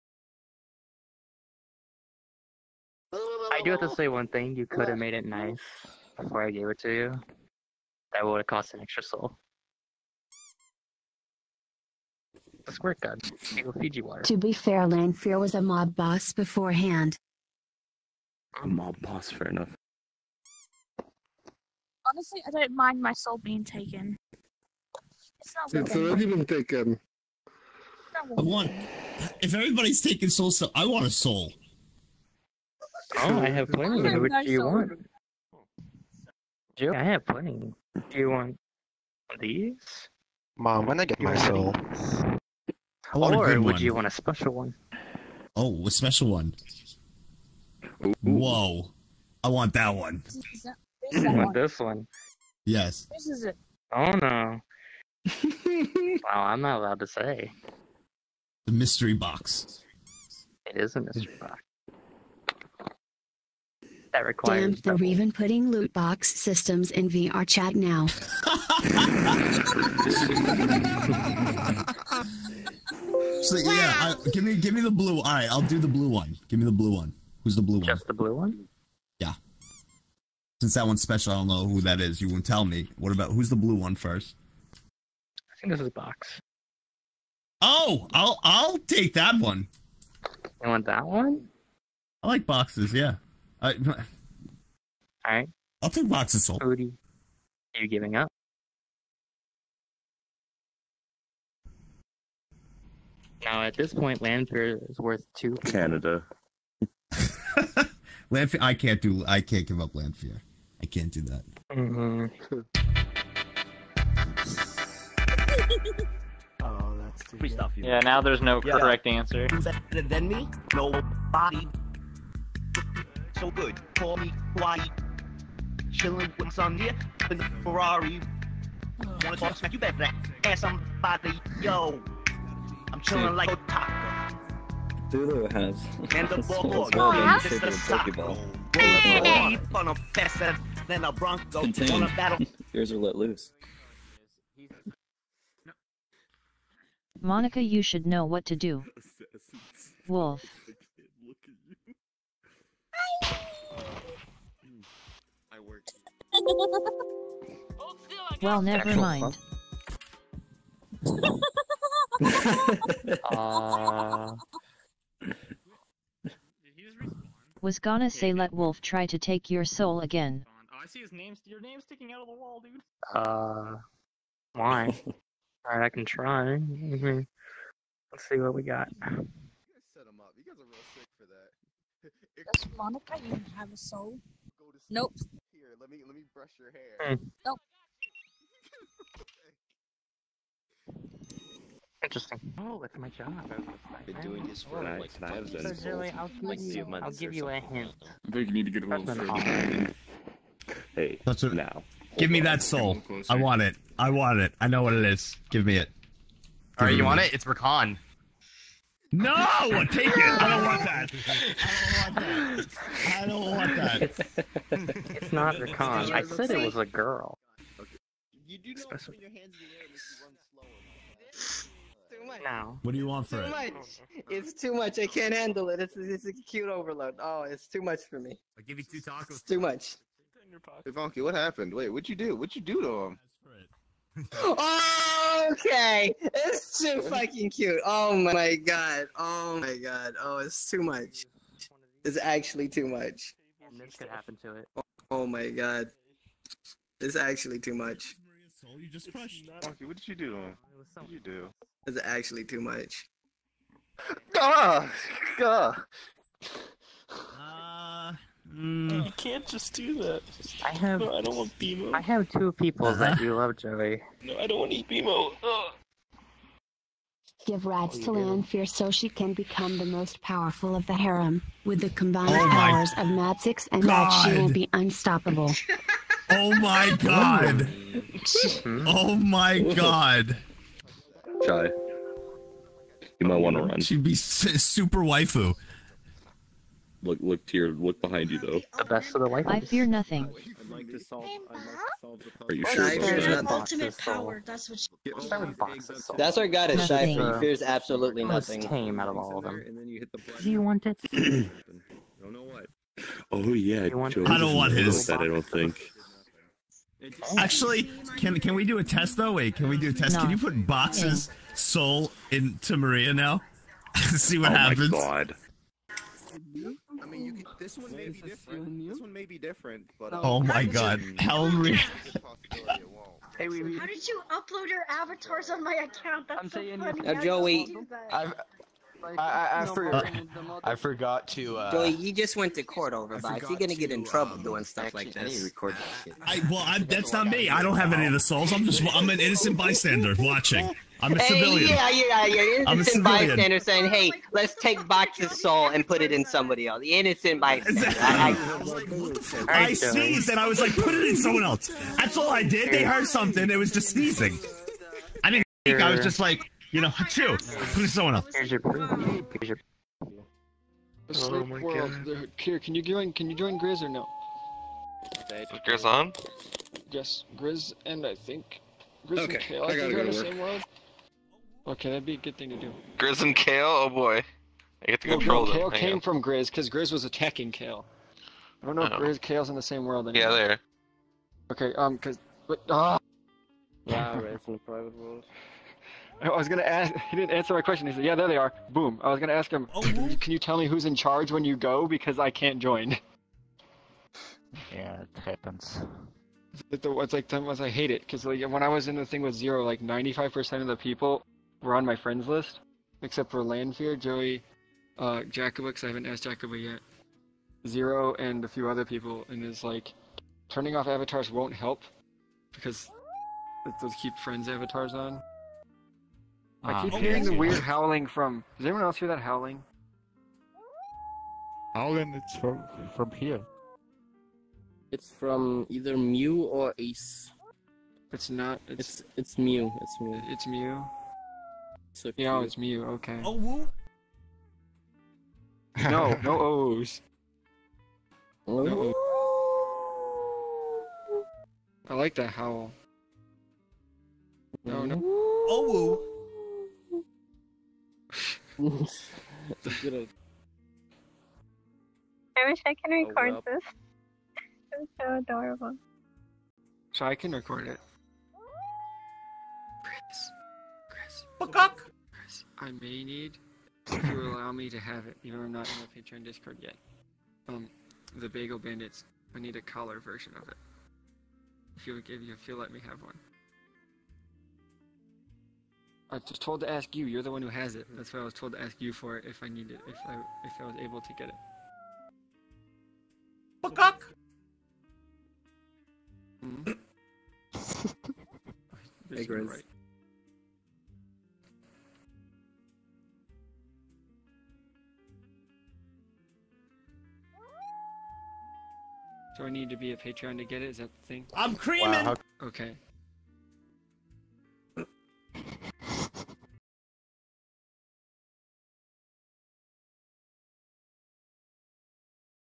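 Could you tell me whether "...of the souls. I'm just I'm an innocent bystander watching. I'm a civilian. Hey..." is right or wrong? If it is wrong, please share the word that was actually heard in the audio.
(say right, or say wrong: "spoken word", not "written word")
right.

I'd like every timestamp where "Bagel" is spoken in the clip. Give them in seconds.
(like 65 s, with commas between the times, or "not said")
468 s.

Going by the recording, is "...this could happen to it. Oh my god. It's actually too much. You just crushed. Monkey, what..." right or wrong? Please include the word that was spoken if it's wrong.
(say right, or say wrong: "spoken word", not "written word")
right.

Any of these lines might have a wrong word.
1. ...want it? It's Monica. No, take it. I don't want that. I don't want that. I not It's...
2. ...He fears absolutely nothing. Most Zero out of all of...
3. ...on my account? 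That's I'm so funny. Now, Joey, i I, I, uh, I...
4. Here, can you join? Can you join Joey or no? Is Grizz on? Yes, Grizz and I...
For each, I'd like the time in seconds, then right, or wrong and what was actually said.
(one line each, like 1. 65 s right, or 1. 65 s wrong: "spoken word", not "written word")
1. 207 s wrong: "Rakan", not "Monica"
2. 297 s wrong: "Tame", not "Zero"
3. 325 s right
4. 362 s wrong: "Grizz", not "Joey".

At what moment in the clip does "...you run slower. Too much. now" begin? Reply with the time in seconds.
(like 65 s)
219 s.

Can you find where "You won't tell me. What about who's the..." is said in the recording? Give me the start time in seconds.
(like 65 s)
82 s.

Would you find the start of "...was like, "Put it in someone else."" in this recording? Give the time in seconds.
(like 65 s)
350 s.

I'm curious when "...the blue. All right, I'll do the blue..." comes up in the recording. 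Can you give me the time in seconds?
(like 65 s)
74 s.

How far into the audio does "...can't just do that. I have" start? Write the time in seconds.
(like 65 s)
259 s.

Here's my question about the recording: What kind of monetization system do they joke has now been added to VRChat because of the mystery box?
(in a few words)
Loot box systems.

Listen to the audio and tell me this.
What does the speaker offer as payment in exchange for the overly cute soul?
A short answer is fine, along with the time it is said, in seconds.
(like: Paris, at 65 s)
Two tacos, at 228 s.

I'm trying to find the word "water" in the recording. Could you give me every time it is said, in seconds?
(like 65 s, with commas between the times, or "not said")
14 s.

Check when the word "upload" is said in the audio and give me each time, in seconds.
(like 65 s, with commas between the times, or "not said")
324 s.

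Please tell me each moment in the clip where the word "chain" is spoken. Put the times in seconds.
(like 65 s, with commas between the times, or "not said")
not said.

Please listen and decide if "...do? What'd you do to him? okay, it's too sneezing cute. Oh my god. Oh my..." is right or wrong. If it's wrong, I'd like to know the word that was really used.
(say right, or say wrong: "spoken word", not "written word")
wrong: "fucking", not "sneezing".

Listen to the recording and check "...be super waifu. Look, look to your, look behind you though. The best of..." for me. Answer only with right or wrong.
right.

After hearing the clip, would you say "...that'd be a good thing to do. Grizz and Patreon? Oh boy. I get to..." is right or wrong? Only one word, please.
wrong.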